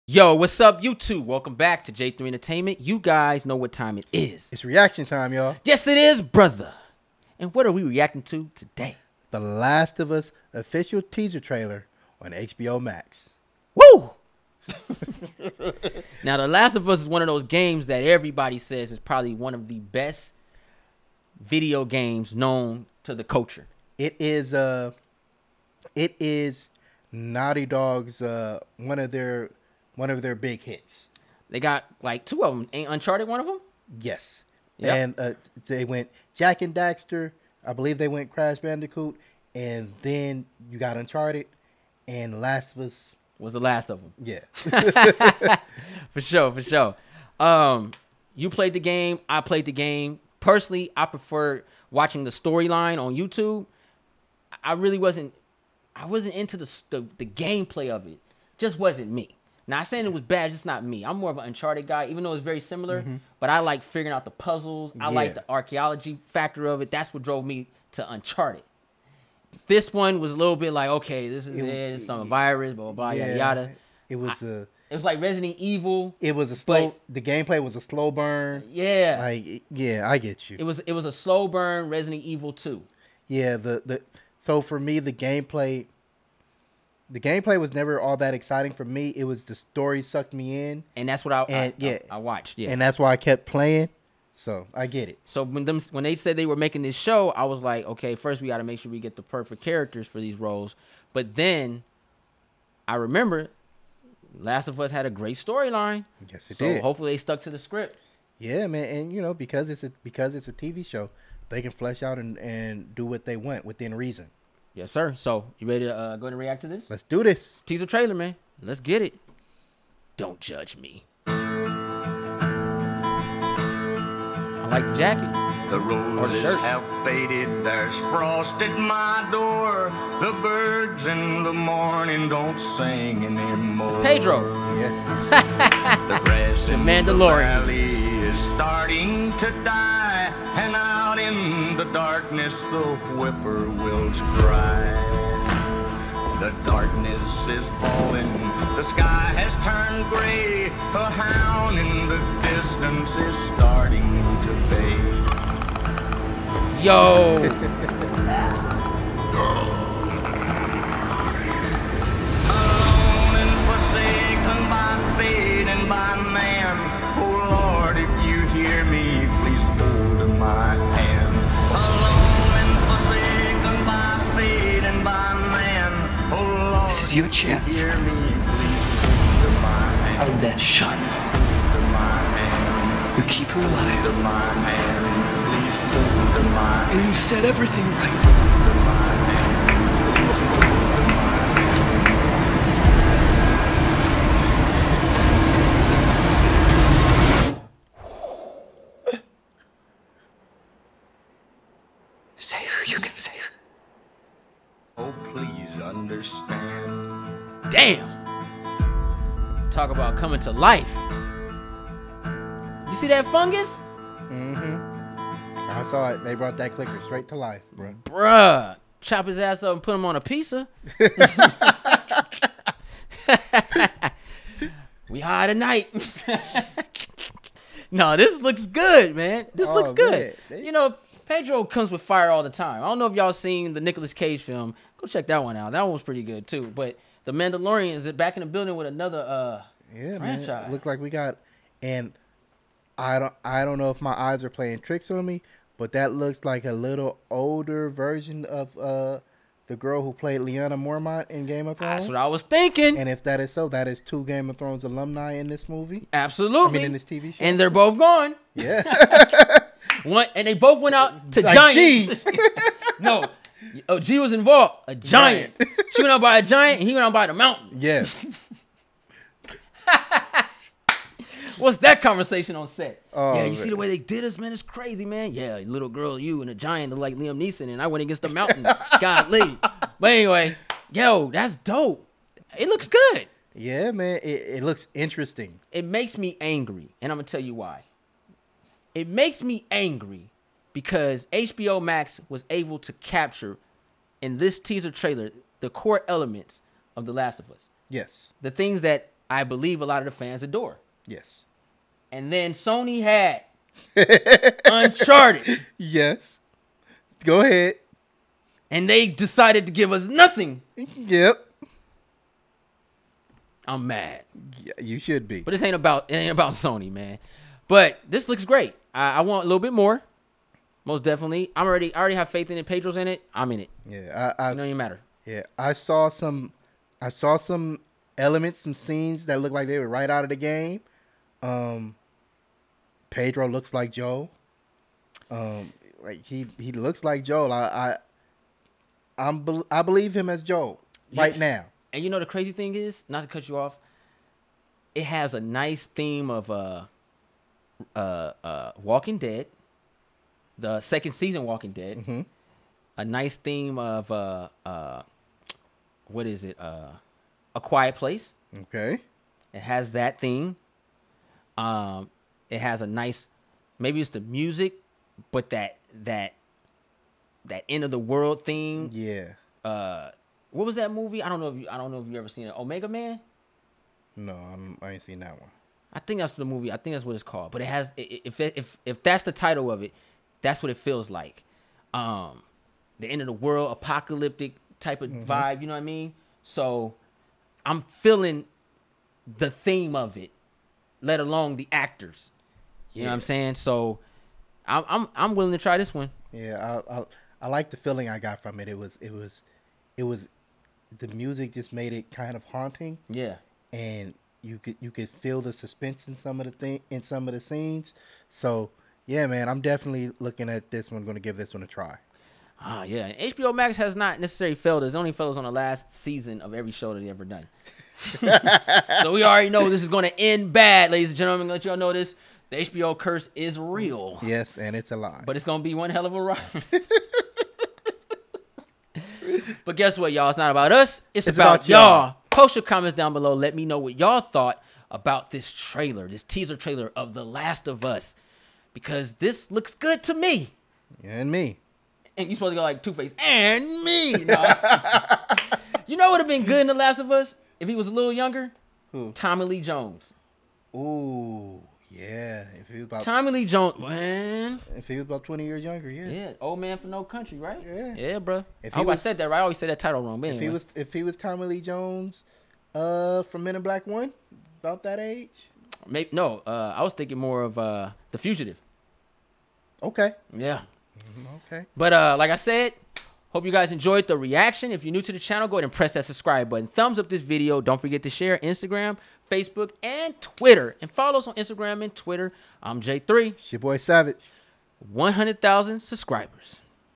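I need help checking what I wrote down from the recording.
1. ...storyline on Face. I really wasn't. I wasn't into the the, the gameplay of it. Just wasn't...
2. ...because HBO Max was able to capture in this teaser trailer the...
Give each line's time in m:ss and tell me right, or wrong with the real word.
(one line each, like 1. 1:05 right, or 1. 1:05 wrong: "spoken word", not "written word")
1. 0:52 wrong: "YouTube", not "Face"
2. 4:50 right.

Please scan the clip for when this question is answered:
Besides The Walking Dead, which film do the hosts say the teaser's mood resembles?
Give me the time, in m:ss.
5:57.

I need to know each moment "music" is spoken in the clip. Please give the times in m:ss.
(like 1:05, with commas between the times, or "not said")
6:04, 6:41.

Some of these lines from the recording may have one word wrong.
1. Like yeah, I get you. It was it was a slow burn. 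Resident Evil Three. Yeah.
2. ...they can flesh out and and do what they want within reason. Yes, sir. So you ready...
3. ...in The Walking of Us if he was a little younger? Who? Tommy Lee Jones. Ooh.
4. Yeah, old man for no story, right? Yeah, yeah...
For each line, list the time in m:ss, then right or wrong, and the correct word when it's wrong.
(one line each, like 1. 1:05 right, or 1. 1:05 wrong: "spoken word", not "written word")
1. 1:19 wrong: "Two", not "Three"
2. 1:51 right
3. 7:26 wrong: "Last", not "Walking"
4. 7:36 wrong: "country", not "story".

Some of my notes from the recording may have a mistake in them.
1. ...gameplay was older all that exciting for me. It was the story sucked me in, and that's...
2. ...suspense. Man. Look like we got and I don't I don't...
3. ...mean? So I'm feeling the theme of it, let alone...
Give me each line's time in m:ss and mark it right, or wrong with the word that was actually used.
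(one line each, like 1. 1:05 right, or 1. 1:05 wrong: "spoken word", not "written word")
1. 1:27 wrong: "never", not "older"
2. 4:00 wrong: "franchise", not "suspense"
3. 6:25 right.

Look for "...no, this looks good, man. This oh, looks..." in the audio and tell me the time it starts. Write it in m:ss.
3:47.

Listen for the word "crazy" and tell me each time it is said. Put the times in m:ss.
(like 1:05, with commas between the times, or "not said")
4:34, 5:42.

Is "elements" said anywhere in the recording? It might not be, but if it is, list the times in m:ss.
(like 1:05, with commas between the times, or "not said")
4:56, 5:28.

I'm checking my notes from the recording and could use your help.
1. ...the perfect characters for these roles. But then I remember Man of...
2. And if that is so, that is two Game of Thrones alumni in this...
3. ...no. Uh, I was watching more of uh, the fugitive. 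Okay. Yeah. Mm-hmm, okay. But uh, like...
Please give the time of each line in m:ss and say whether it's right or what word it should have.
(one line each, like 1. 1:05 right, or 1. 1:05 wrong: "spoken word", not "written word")
1. 1:39 wrong: "Last", not "Man"
2. 4:12 right
3. 7:46 wrong: "thinking", not "watching".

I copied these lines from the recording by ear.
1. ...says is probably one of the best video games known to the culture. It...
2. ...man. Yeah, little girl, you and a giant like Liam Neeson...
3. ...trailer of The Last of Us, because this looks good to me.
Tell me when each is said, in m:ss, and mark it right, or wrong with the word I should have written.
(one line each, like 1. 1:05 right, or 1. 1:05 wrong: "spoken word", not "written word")
1. 0:18 right
2. 4:35 right
3. 7:16 right.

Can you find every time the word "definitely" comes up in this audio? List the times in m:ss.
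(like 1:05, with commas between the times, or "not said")
5:21, 6:49.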